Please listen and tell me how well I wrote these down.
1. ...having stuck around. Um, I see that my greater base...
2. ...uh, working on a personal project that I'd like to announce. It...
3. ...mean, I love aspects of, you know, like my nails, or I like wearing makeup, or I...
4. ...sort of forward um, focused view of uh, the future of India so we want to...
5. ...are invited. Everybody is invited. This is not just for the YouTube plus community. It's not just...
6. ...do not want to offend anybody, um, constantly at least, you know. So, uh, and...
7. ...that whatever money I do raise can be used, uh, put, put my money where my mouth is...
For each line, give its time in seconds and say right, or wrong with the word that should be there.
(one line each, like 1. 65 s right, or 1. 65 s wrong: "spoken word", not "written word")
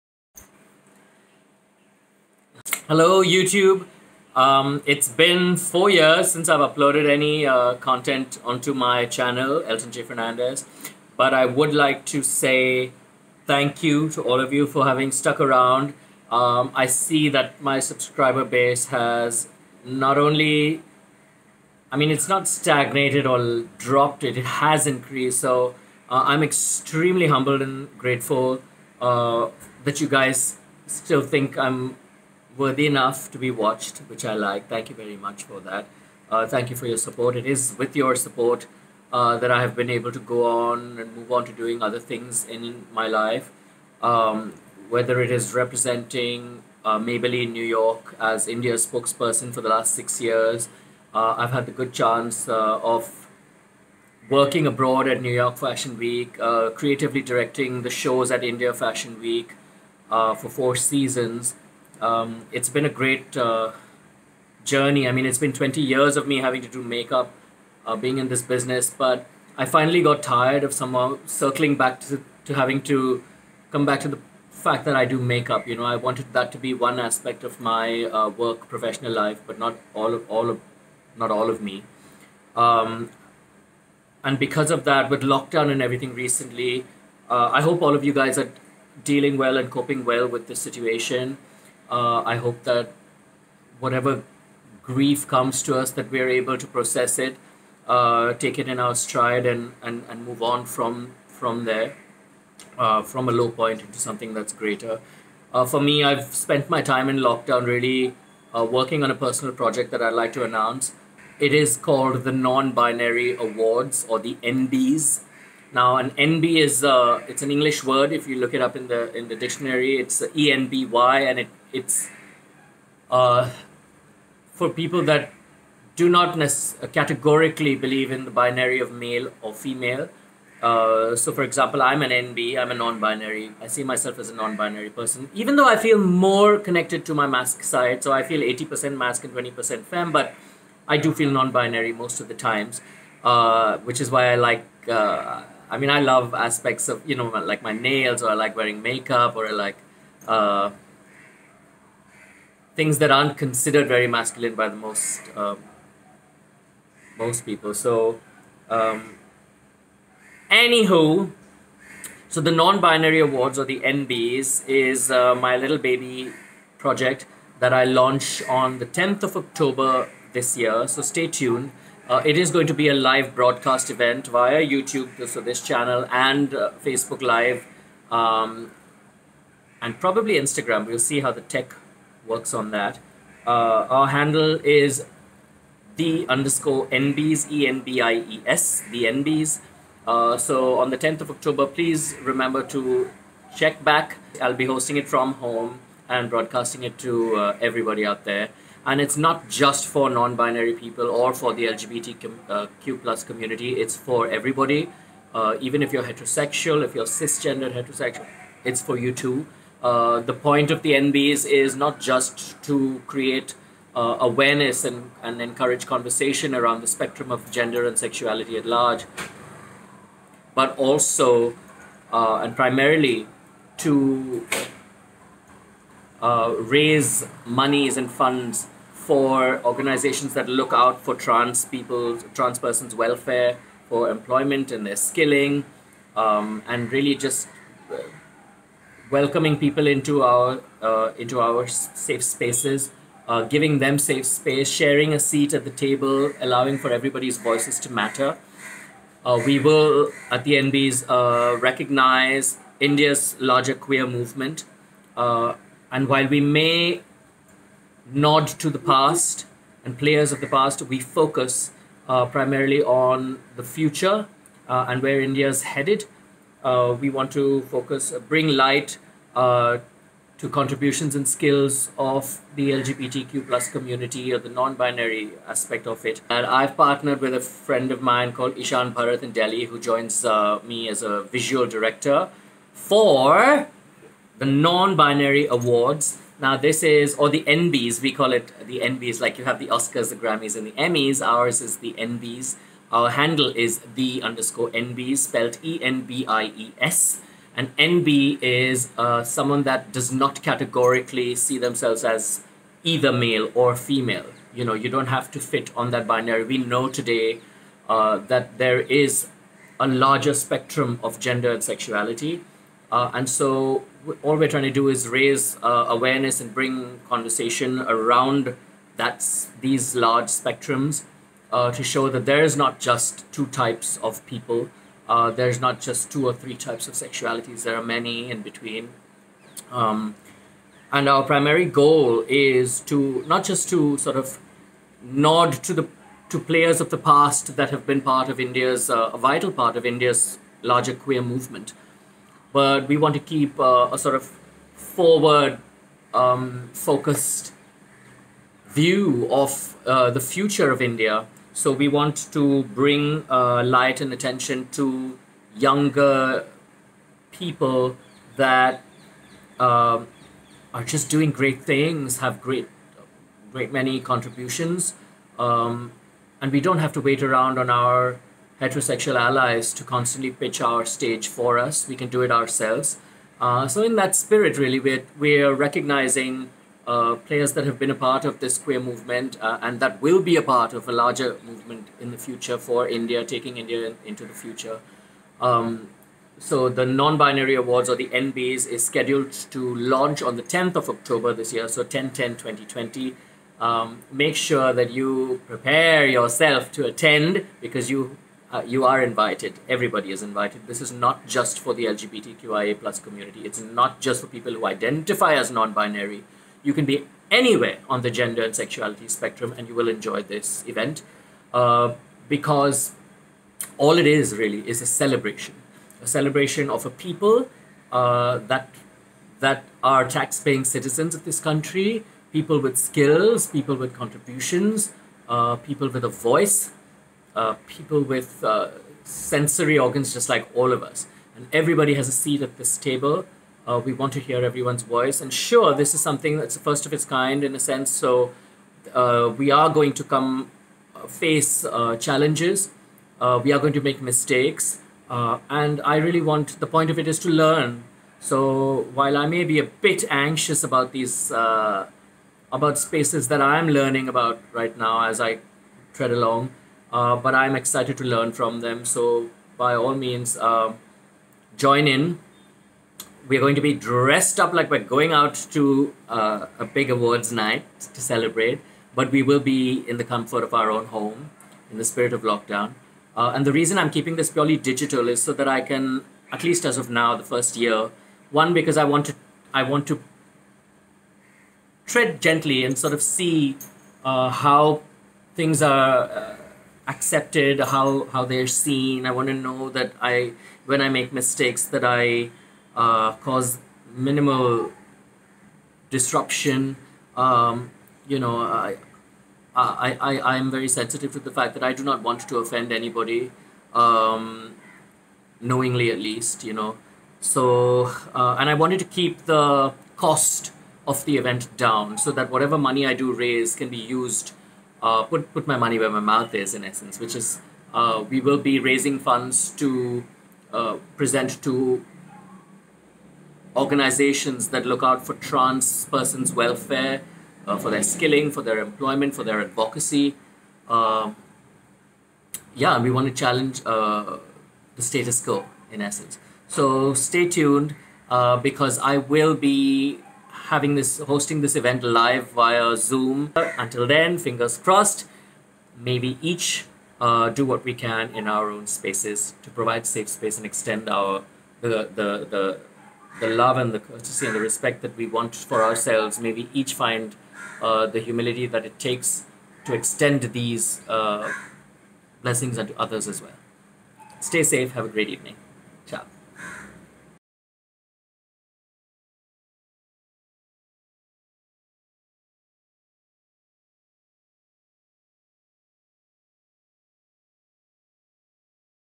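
1. 14 s wrong: "subscriber", not "greater"
2. 108 s right
3. 145 s right
4. 343 s right
5. 398 s wrong: "LGBTQIA", not "YouTube"
6. 501 s wrong: "knowingly", not "constantly"
7. 512 s right.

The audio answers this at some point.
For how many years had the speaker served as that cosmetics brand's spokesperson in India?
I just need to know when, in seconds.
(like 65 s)
49 s.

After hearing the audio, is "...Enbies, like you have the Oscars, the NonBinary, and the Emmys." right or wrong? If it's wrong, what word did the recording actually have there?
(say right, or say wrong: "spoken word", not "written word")
wrong: "Grammys", not "NonBinary".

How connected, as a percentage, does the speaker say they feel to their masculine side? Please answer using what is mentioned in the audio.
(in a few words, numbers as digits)
80%.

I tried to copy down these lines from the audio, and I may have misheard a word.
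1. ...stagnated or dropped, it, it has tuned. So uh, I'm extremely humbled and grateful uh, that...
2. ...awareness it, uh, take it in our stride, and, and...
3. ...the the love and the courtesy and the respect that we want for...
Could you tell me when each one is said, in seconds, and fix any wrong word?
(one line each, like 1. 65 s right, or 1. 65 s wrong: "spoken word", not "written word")
1. 22 s wrong: "increased", not "tuned"
2. 96 s wrong: "process", not "awareness"
3. 552 s right.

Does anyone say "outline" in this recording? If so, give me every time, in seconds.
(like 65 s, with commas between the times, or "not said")
not said.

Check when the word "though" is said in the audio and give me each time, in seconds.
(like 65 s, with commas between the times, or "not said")
135 s.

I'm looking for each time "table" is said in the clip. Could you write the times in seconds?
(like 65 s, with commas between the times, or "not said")
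245 s, 432 s.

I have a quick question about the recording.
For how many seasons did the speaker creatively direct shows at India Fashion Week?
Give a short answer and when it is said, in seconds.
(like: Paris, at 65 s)
4, at 60 s.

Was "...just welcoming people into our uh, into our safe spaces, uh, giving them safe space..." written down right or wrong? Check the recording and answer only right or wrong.
right.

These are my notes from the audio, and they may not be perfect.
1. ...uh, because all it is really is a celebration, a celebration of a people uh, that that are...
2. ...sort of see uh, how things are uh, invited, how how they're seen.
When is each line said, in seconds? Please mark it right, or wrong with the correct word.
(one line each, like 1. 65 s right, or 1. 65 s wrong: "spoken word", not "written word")
1. 411 s right
2. 482 s wrong: "accepted", not "invited".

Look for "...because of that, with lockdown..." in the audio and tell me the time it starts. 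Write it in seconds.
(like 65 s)
84 s.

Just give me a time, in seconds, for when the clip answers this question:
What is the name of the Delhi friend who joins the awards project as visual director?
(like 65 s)
278 s.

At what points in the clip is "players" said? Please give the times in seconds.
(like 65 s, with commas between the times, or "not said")
259 s, 336 s, 377 s.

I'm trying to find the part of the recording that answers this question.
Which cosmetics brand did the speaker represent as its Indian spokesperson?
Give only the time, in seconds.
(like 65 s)
46 s.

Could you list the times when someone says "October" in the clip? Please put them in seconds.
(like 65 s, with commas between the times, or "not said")
169 s, 191 s, 390 s.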